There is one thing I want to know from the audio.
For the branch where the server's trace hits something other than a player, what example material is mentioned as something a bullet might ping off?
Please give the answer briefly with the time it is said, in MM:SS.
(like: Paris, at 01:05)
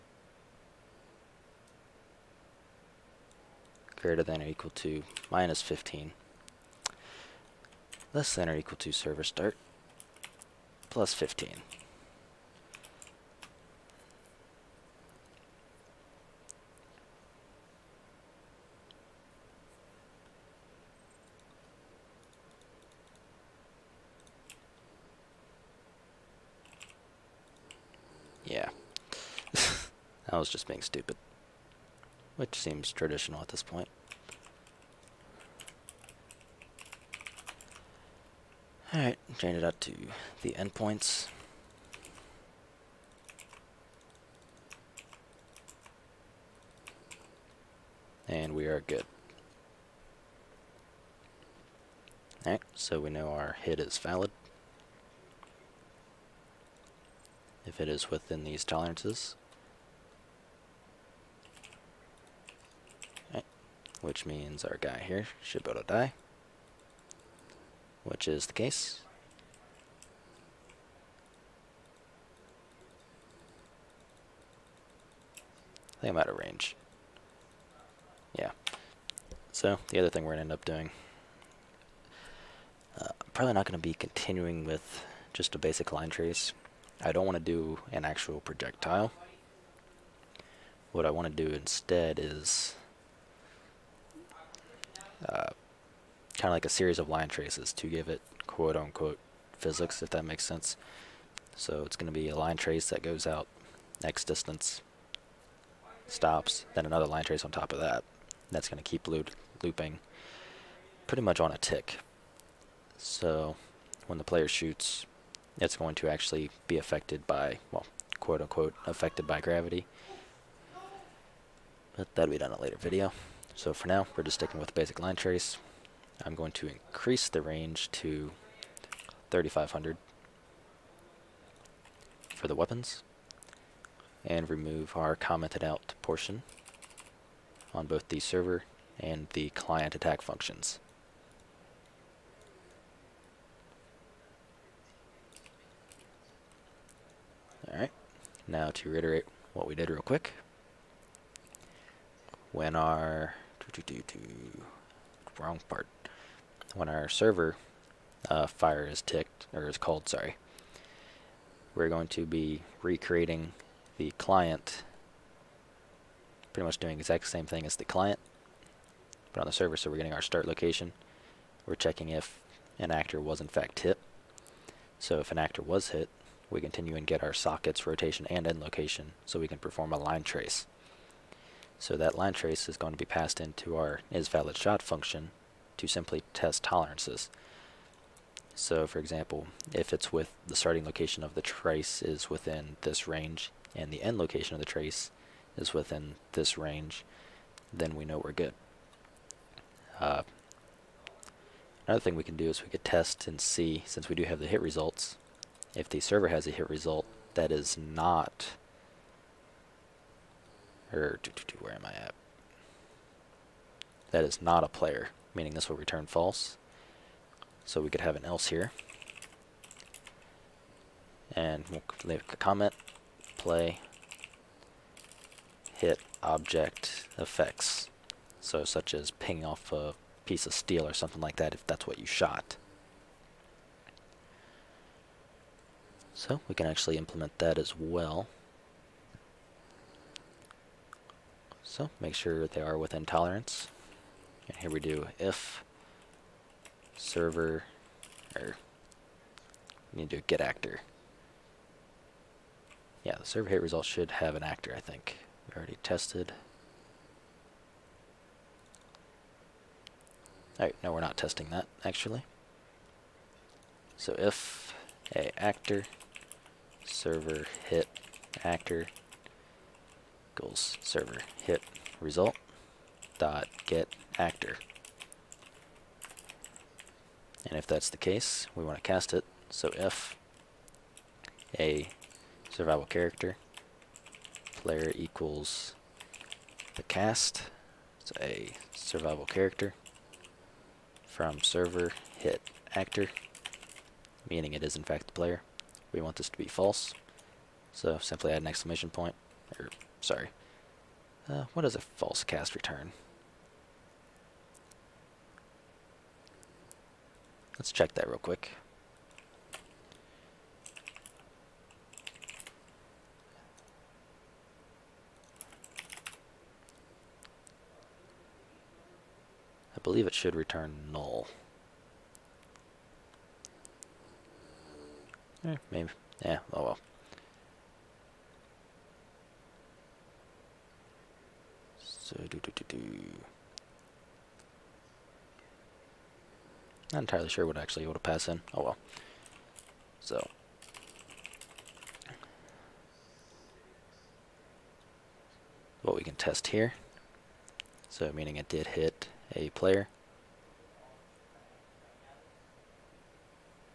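steel, at 03:50.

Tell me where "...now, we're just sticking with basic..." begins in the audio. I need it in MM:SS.
02:03.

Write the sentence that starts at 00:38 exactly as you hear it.
Alright, change it out to the endpoints.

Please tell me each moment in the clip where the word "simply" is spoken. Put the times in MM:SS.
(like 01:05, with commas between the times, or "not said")
03:05, 04:58.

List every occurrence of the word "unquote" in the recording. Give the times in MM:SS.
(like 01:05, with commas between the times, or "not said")
01:38, 01:58.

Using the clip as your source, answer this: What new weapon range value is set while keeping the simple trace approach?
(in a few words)
3500.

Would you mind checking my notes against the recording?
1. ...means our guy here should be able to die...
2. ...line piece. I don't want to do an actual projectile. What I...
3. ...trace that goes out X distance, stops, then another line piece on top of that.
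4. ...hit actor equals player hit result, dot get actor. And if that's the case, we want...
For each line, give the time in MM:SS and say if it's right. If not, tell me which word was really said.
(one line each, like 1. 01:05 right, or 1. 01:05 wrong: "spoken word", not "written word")
1. 01:04 right
2. 01:25 wrong: "trace", not "piece"
3. 01:42 wrong: "trace", not "piece"
4. 04:27 wrong: "server", not "player".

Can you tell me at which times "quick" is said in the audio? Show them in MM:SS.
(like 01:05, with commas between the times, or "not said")
02:30, 05:08.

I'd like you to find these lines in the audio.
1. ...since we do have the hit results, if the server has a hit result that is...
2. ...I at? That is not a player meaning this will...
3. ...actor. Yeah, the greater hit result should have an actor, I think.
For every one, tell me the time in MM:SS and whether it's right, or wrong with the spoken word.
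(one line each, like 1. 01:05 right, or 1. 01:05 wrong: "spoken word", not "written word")
1. 03:23 right
2. 03:31 right
3. 04:10 wrong: "server", not "greater".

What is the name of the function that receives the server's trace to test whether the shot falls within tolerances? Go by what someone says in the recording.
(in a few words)
isValidShot.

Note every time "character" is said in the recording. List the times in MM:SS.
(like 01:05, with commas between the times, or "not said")
04:42, 04:49.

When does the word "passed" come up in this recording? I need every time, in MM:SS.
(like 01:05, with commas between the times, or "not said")
03:03, 05:38.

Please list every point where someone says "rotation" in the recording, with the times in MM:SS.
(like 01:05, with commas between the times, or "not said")
02:57.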